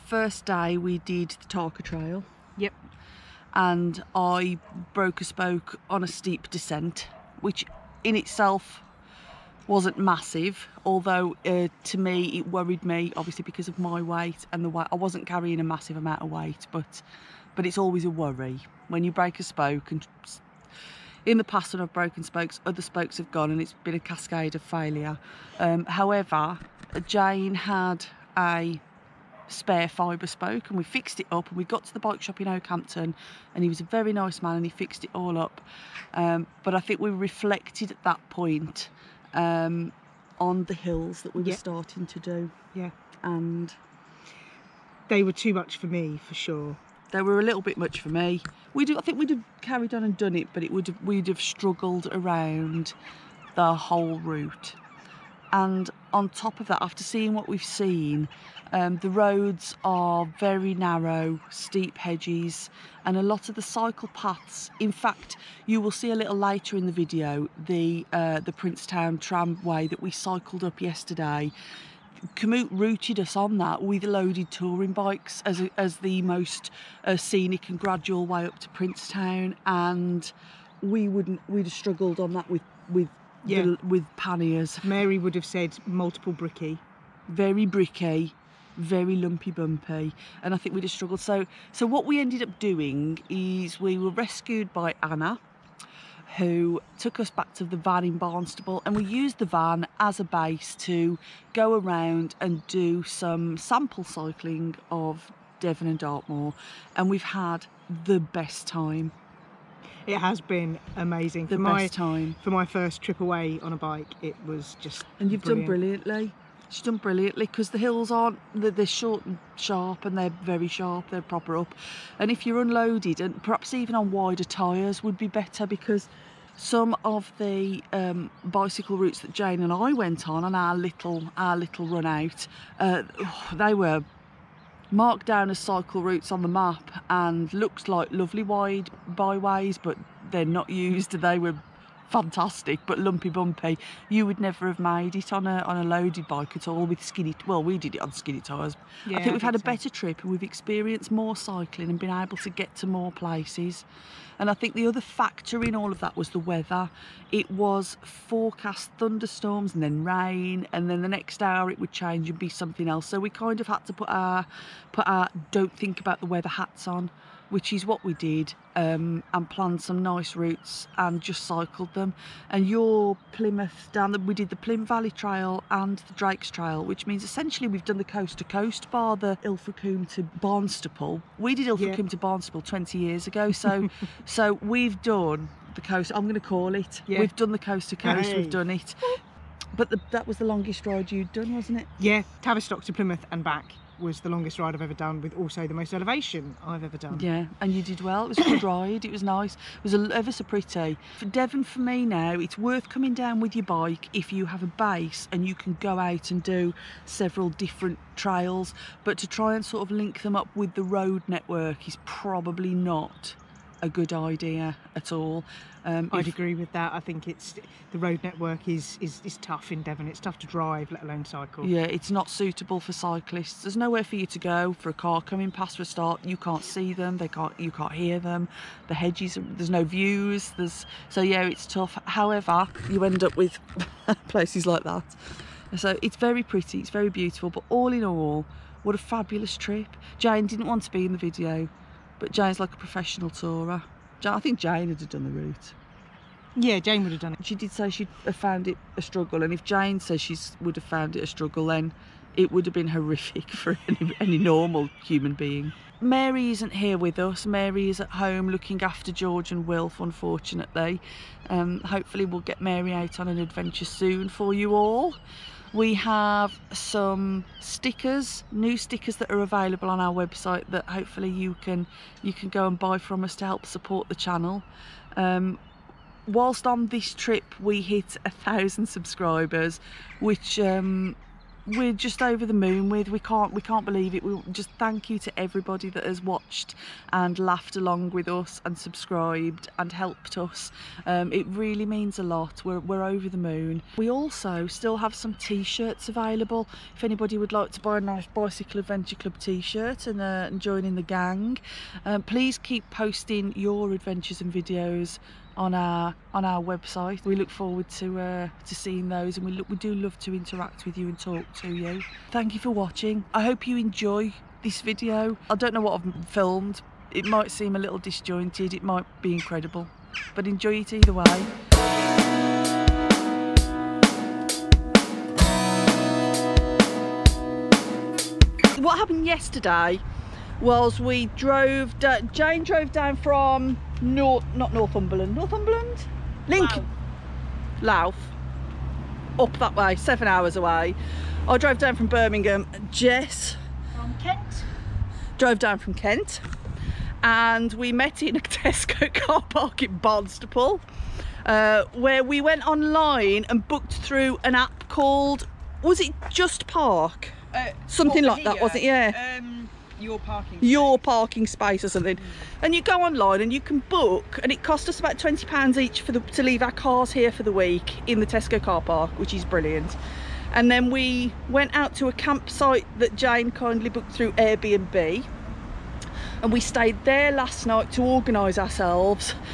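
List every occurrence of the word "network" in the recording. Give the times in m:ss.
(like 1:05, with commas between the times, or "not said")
3:31, 3:38.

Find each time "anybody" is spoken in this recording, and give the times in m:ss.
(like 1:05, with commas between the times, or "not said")
4:57.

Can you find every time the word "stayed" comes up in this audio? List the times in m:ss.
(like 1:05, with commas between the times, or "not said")
6:16.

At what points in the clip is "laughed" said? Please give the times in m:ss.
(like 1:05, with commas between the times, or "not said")
4:47.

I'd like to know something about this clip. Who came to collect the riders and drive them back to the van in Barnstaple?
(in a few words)
Anna.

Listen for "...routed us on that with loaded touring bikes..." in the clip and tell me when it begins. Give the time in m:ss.
1:12.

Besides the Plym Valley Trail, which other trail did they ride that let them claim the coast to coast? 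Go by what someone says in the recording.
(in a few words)
Drake's Trail.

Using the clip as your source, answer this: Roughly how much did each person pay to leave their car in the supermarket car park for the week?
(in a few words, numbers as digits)
20 pounds.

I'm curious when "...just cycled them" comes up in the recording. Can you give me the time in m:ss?
2:51.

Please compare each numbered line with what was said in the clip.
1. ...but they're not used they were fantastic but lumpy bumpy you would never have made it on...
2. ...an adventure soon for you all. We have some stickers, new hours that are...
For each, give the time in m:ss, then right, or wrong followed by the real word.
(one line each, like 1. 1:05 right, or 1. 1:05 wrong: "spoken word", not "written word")
1. 2:19 right
2. 4:23 wrong: "stickers", not "hours".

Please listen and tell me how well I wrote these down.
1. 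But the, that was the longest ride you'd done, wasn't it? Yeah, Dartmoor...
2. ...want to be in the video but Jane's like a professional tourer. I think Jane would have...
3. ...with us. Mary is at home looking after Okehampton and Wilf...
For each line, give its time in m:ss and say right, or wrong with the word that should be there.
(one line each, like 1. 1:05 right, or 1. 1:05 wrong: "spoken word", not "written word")
1. 3:09 wrong: "Tavistock", not "Dartmoor"
2. 4:00 right
3. 4:16 wrong: "George", not "Okehampton".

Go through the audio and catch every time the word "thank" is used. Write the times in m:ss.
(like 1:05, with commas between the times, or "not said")
4:44, 5:12.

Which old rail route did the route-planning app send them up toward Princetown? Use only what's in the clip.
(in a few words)
Princetown tramway.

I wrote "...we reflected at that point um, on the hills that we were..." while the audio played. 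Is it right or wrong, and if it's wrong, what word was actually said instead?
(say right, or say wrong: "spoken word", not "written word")
right.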